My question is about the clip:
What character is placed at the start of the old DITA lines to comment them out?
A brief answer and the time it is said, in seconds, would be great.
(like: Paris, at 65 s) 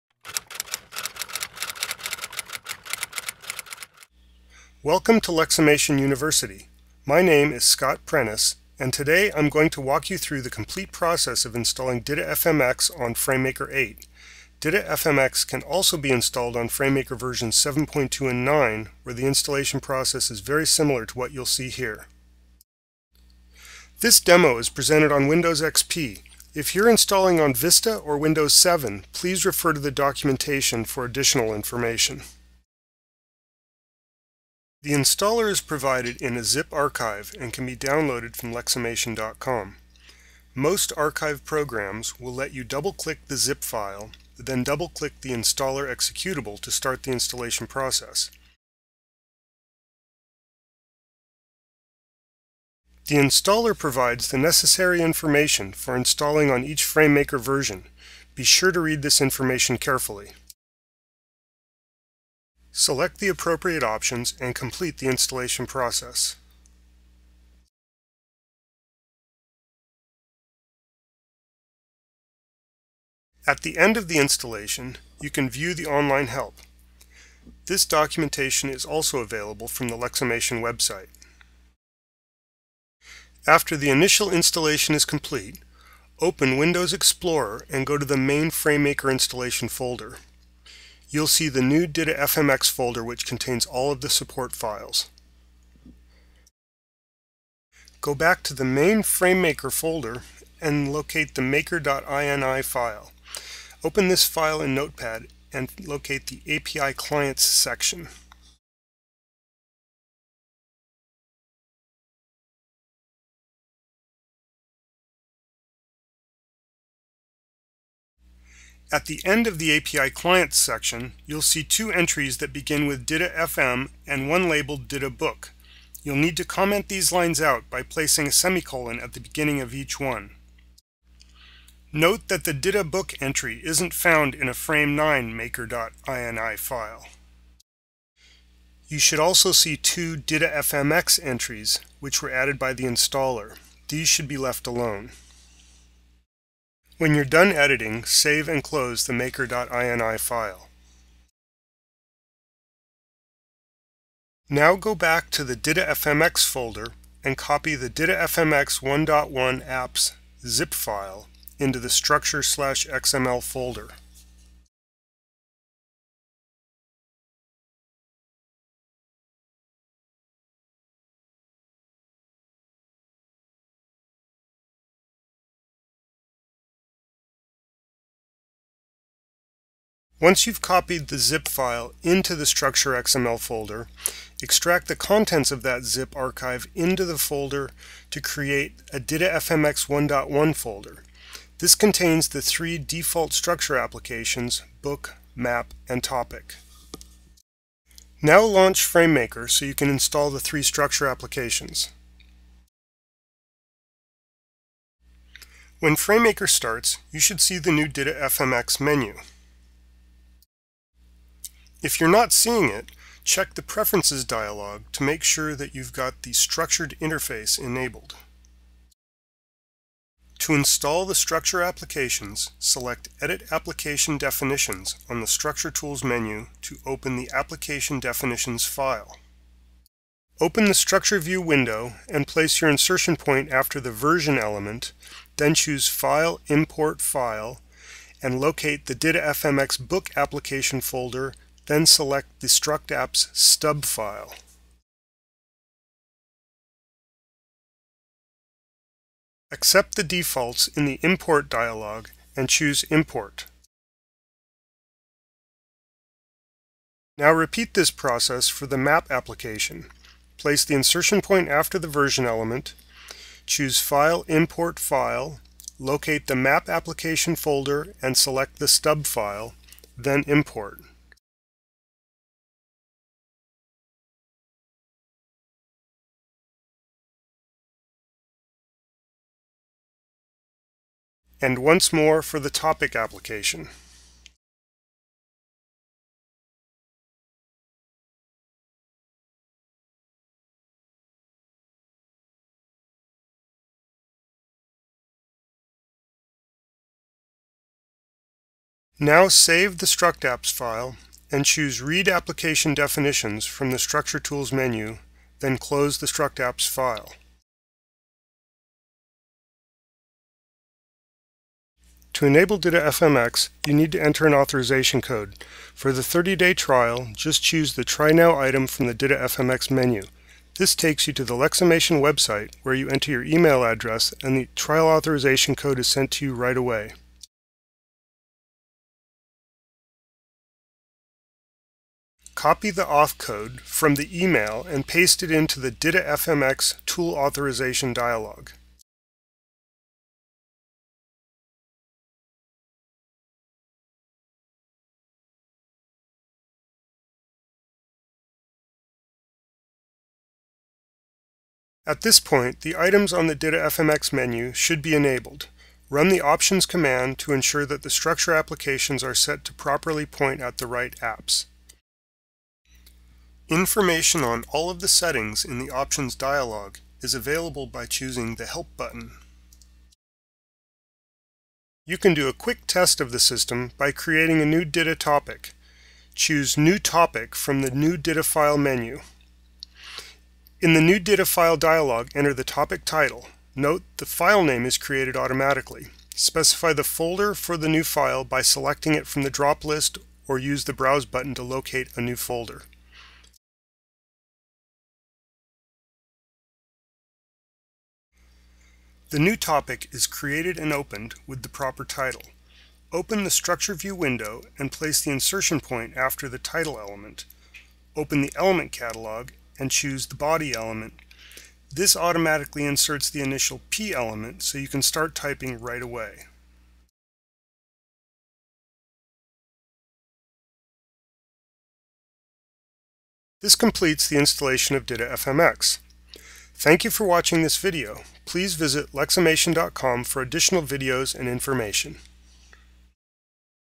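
a semicolon, at 128 s.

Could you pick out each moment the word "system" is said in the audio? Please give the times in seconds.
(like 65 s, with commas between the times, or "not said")
373 s.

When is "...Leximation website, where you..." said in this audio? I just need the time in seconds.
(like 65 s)
321 s.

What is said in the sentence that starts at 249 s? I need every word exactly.
Accept the defaults in the Import dialog and choose Import.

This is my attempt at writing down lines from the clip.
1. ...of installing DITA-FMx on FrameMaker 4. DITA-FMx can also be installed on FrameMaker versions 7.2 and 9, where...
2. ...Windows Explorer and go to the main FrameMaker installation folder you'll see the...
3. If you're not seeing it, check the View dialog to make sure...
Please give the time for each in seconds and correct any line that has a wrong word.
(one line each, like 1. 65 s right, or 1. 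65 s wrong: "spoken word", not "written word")
1. 11 s wrong: "8", not "4"
2. 86 s right
3. 211 s wrong: "Preferences", not "View".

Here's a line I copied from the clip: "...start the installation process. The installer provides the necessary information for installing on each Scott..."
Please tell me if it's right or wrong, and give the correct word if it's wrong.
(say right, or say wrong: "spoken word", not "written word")
wrong: "FrameMaker", not "Scott".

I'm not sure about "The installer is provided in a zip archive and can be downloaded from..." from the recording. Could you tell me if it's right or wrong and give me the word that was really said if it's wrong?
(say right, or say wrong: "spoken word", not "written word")
right.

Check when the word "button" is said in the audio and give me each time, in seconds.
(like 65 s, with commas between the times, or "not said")
368 s, 391 s.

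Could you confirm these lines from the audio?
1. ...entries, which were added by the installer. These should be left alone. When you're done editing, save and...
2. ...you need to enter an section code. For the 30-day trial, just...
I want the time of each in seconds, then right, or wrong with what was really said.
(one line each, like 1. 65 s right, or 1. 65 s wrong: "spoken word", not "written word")
1. 141 s right
2. 313 s wrong: "authorization", not "section".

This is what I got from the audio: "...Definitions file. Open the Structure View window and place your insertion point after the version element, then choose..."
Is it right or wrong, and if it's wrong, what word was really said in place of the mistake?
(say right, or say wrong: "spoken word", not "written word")
right.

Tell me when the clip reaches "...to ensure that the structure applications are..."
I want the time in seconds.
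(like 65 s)
357 s.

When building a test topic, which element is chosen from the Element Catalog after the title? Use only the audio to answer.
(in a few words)
body.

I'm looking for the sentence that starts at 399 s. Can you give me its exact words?
The new topic is created and opened with the proper title.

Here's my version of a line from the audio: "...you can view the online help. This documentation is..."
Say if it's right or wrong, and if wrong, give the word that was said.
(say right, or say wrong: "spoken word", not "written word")
right.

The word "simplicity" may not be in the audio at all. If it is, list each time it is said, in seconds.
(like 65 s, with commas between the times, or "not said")
not said.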